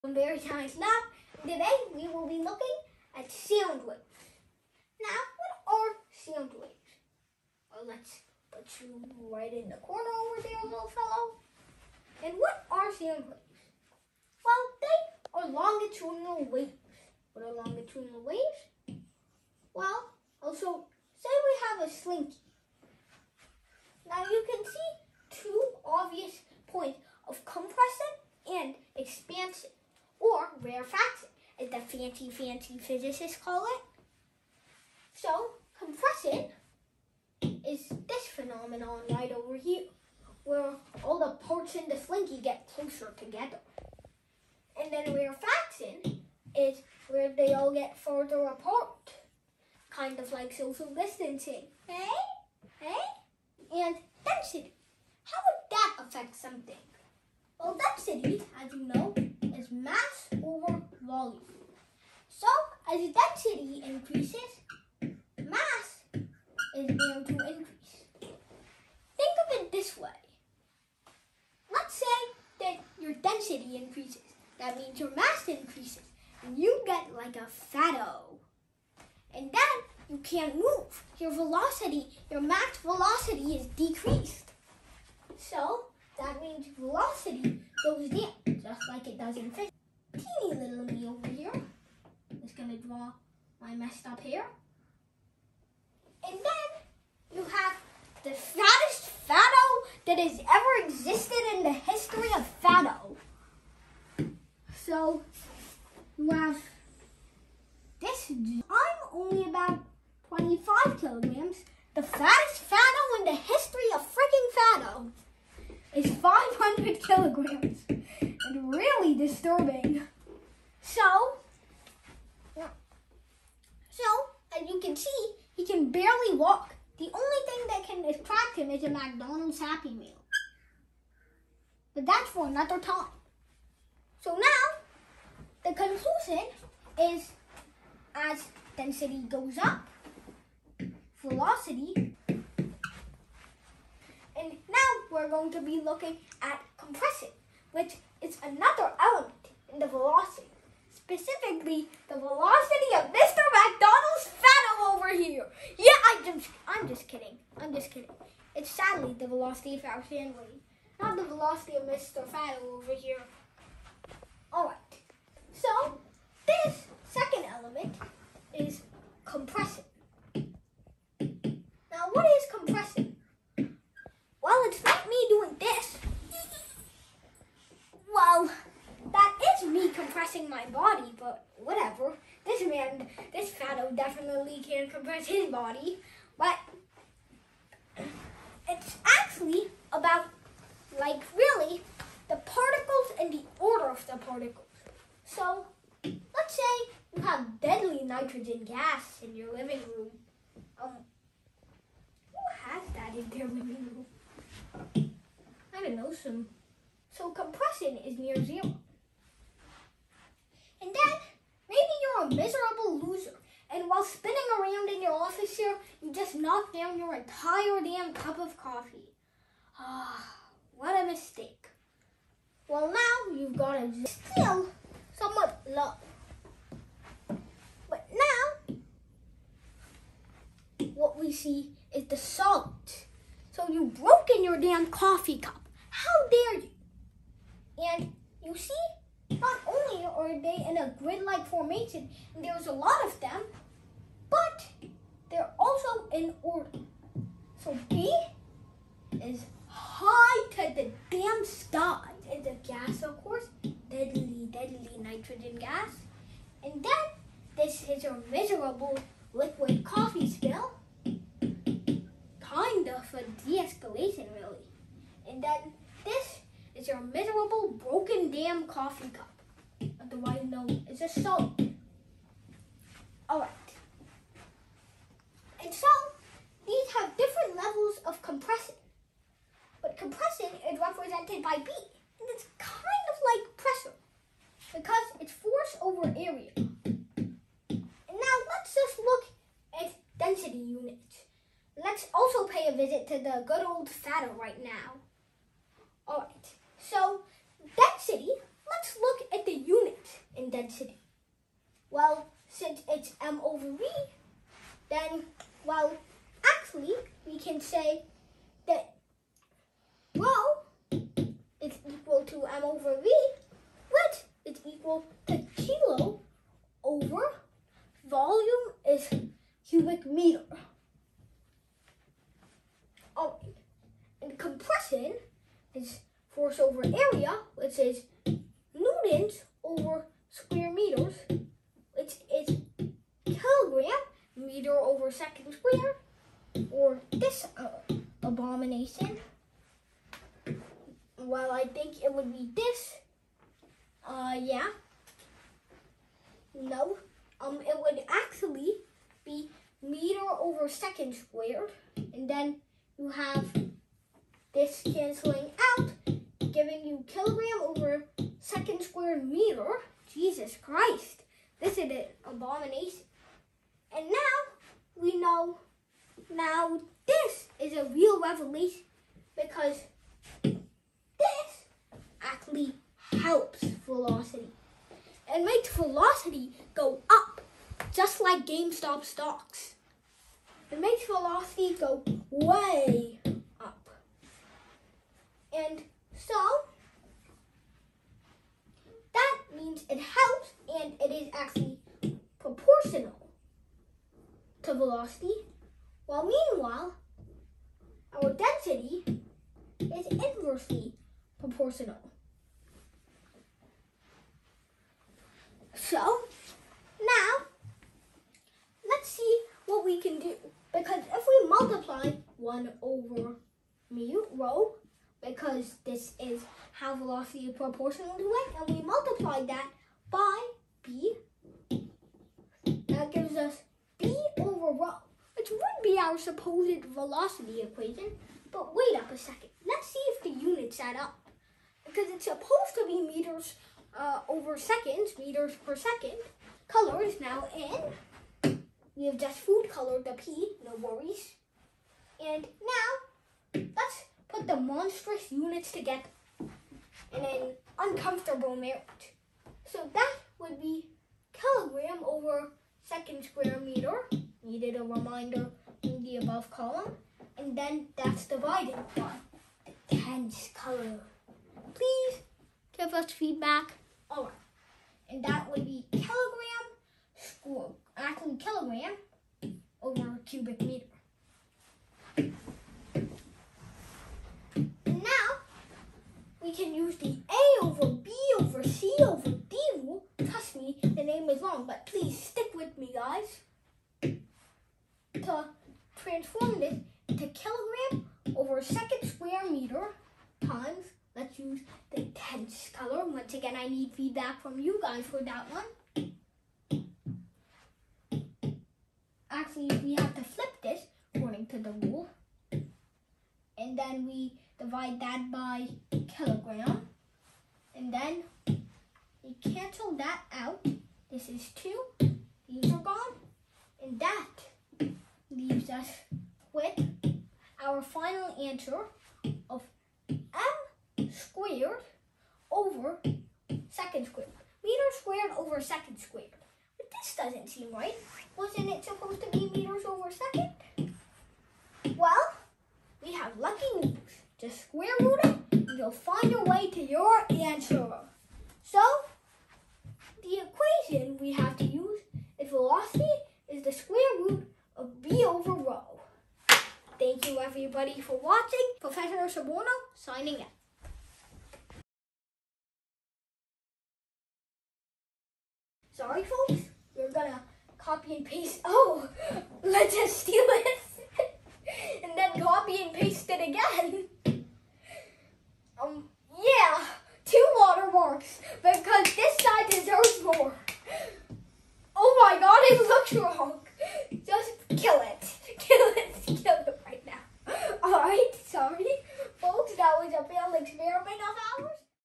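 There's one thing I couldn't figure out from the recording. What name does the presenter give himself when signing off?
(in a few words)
Professor Soborno.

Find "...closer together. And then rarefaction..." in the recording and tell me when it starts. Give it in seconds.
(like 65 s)
42 s.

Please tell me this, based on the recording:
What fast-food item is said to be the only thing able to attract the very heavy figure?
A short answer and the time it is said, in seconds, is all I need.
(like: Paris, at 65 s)
McDonald's Happy Meal, at 128 s.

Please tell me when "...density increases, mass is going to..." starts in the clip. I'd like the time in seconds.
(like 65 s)
63 s.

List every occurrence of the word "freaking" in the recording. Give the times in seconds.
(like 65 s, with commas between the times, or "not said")
114 s.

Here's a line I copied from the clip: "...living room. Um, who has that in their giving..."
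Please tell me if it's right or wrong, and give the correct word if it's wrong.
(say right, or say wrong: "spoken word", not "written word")
wrong: "living", not "giving".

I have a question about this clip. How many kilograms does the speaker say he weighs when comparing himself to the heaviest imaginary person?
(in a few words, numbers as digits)
25 kilograms.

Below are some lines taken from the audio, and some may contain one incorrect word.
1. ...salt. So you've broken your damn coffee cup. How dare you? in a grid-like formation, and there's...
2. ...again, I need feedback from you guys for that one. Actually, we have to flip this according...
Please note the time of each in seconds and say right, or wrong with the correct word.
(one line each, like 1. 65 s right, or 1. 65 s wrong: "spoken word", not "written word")
1. 232 s right
2. 493 s right.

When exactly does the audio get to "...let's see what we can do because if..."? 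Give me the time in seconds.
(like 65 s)
408 s.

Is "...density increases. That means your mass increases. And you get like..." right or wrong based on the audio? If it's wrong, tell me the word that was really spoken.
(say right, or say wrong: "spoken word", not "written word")
right.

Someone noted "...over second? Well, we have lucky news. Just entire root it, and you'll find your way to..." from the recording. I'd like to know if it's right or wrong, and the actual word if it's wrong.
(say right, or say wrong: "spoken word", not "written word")
wrong: "square", not "entire".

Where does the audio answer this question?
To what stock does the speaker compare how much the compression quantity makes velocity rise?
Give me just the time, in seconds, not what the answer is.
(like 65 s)
378 s.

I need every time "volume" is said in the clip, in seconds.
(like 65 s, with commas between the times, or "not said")
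61 s, 318 s.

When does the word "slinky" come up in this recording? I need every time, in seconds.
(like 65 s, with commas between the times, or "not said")
21 s, 41 s.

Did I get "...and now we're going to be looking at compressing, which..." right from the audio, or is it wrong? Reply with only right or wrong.
right.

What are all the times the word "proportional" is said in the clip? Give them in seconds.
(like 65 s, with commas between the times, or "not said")
392 s, 401 s, 417 s.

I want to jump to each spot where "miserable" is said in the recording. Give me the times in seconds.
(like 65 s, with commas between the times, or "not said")
212 s, 258 s, 267 s.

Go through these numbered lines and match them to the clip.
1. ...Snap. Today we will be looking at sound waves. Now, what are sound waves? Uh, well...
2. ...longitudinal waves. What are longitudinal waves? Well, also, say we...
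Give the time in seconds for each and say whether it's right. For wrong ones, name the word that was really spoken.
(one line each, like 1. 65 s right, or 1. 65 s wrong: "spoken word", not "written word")
1. 0 s right
2. 15 s right.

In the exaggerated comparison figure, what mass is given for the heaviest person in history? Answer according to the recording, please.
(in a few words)
500 kilograms.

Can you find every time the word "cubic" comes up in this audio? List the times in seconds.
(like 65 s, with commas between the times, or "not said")
319 s, 470 s.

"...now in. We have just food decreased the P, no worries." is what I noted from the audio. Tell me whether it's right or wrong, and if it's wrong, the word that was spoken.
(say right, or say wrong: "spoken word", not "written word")
wrong: "colored", not "decreased".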